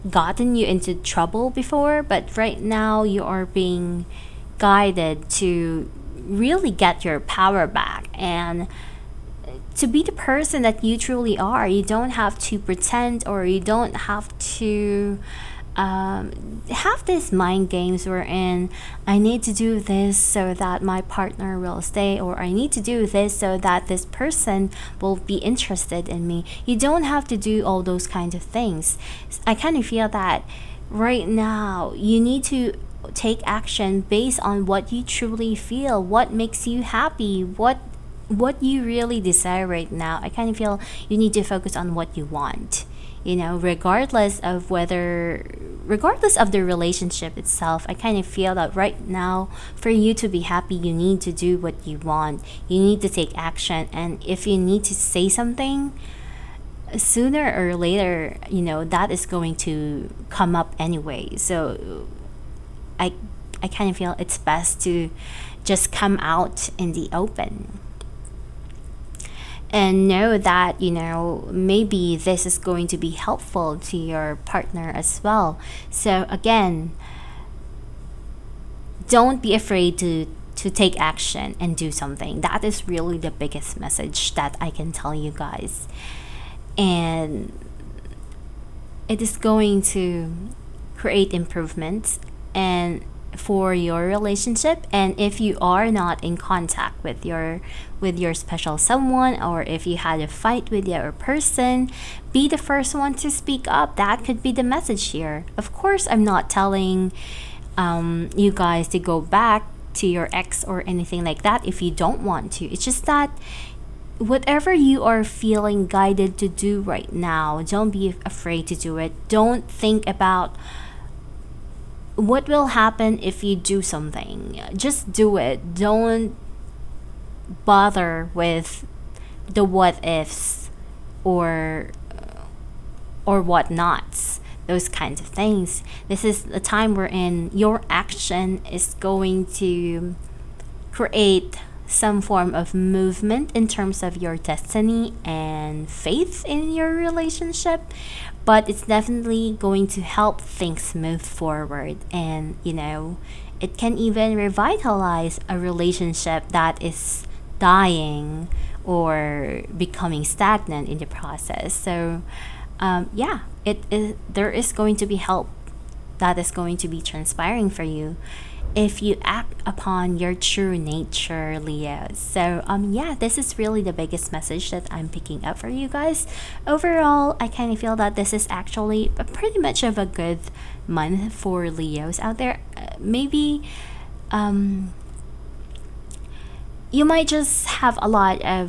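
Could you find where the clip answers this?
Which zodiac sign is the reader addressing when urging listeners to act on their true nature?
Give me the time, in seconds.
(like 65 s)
171 s.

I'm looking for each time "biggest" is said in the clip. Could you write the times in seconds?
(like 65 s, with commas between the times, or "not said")
83 s, 173 s.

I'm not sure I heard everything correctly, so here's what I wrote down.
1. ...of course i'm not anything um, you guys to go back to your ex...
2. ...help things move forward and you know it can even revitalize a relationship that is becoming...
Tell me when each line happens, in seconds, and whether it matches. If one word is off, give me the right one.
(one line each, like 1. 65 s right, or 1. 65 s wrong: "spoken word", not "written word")
1. 105 s wrong: "telling", not "anything"
2. 149 s wrong: "dying", not "becoming".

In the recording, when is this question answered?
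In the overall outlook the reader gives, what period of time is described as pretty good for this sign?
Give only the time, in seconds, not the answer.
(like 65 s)
180 s.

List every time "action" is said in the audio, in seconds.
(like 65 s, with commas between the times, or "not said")
33 s, 53 s, 80 s, 137 s.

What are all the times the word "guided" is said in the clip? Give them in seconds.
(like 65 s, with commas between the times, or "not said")
4 s, 115 s.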